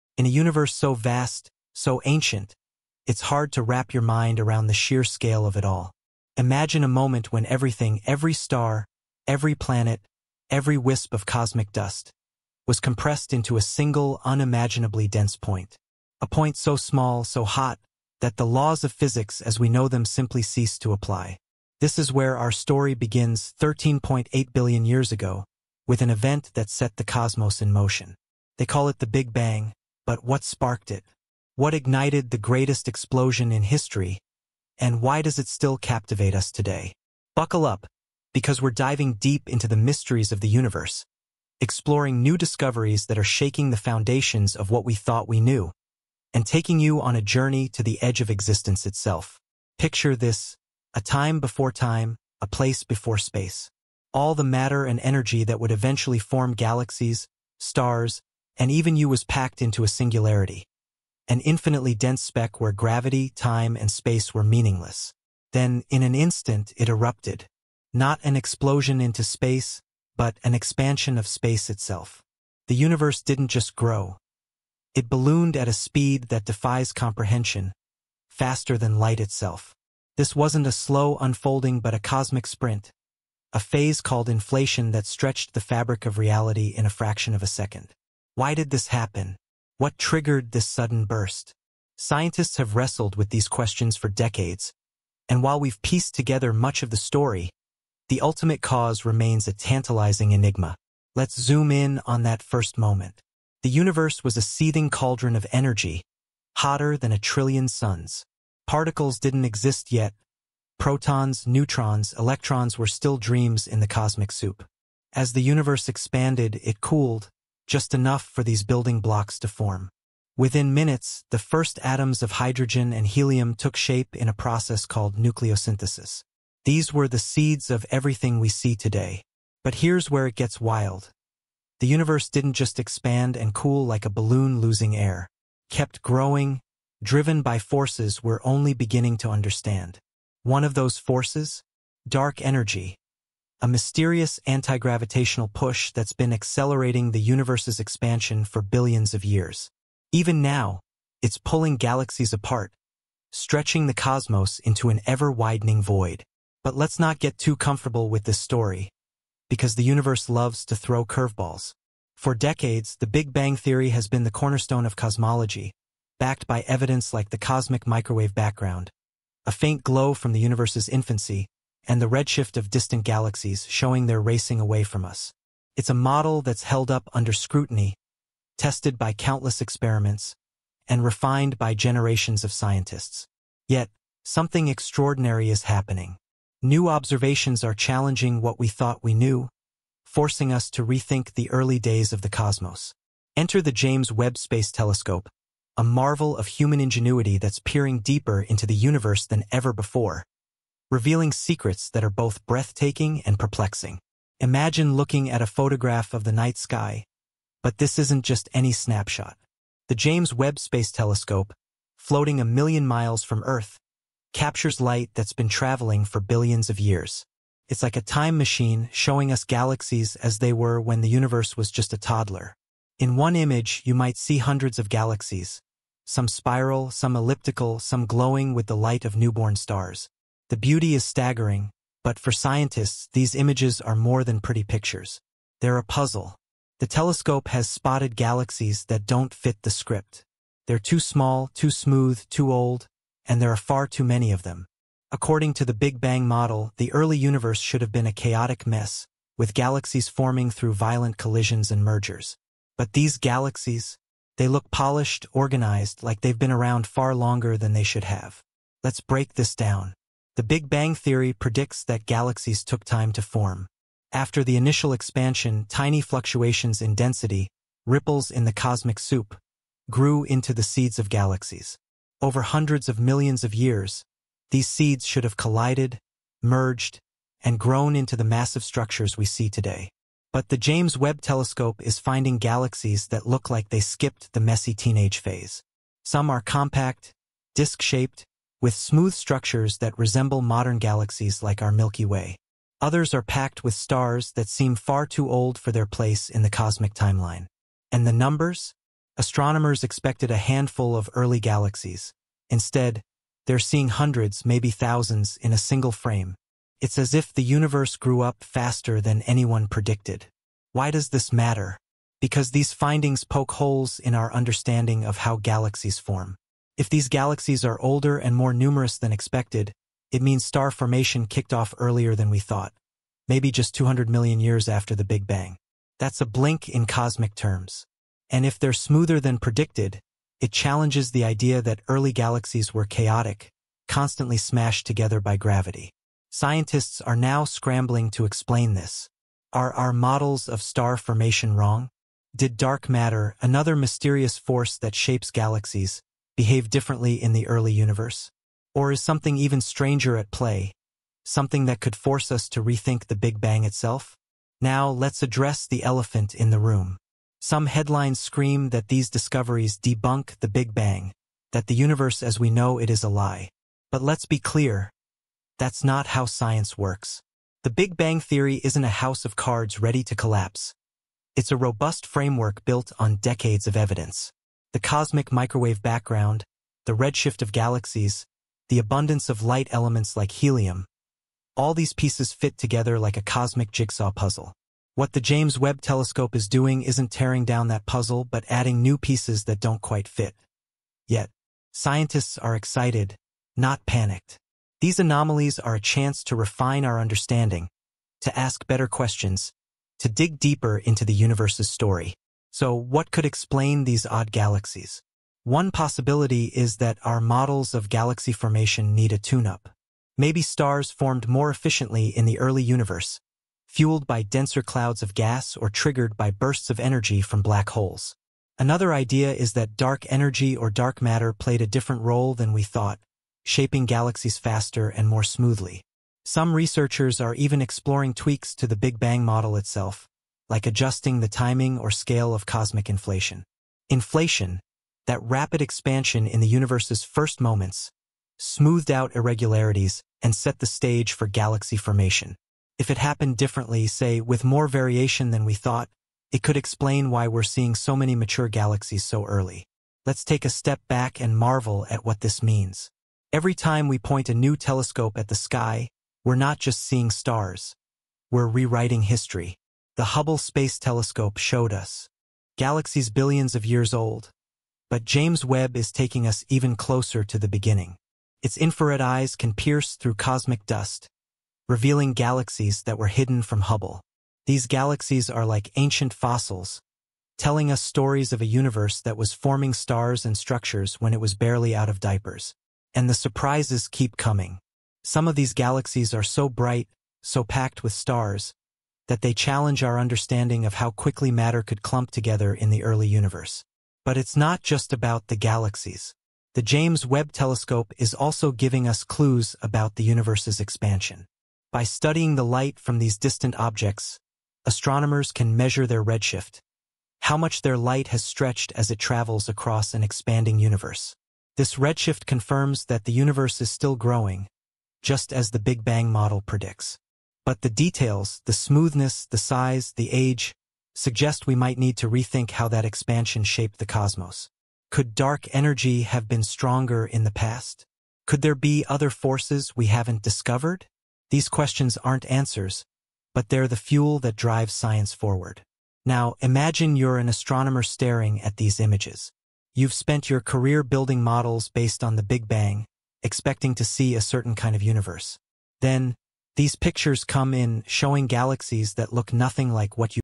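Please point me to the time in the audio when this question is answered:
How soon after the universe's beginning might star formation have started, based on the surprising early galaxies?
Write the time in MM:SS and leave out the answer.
05:23.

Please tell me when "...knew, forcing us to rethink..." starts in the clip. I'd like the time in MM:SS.
03:09.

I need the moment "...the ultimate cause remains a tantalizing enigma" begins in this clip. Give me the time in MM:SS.
01:38.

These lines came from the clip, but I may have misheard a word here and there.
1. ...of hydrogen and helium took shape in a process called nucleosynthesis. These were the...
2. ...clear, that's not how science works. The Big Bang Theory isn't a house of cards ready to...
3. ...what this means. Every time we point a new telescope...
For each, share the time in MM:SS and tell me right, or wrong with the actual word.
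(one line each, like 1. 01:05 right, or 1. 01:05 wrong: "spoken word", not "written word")
1. 02:02 right
2. 06:04 right
3. 07:32 right.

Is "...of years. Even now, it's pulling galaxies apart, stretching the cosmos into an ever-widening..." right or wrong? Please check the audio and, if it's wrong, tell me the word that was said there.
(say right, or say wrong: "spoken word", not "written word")
right.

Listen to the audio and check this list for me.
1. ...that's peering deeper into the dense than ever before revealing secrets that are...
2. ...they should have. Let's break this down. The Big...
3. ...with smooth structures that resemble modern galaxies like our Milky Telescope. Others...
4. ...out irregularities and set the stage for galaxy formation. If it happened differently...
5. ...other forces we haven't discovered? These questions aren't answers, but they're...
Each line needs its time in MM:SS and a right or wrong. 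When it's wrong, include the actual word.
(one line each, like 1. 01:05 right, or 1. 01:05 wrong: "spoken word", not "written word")
1. 03:17 wrong: "universe", not "dense"
2. 04:17 right
3. 04:48 wrong: "Way", not "Telescope"
4. 07:18 right
5. 08:48 right.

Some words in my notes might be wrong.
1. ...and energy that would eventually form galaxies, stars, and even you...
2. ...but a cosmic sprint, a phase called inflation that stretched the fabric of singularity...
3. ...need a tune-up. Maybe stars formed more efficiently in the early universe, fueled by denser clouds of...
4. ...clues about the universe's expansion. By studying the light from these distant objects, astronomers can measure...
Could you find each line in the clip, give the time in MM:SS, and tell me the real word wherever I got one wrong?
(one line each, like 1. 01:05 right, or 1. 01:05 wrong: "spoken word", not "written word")
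1. 00:54 right
2. 01:21 wrong: "reality", not "singularity"
3. 06:48 right
4. 08:19 right.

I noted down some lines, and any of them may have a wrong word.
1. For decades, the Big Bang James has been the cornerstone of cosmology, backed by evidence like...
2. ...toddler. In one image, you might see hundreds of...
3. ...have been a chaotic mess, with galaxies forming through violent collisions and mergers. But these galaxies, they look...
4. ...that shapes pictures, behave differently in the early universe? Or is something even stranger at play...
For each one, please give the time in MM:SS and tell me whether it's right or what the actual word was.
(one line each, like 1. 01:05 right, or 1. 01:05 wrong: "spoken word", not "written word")
1. 02:42 wrong: "Theory", not "James"
2. 03:41 right
3. 04:07 right
4. 05:44 wrong: "galaxies", not "pictures".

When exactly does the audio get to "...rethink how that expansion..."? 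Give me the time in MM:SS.
08:42.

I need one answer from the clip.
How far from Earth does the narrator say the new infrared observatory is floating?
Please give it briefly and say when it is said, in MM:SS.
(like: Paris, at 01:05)
a million miles, at 03:32.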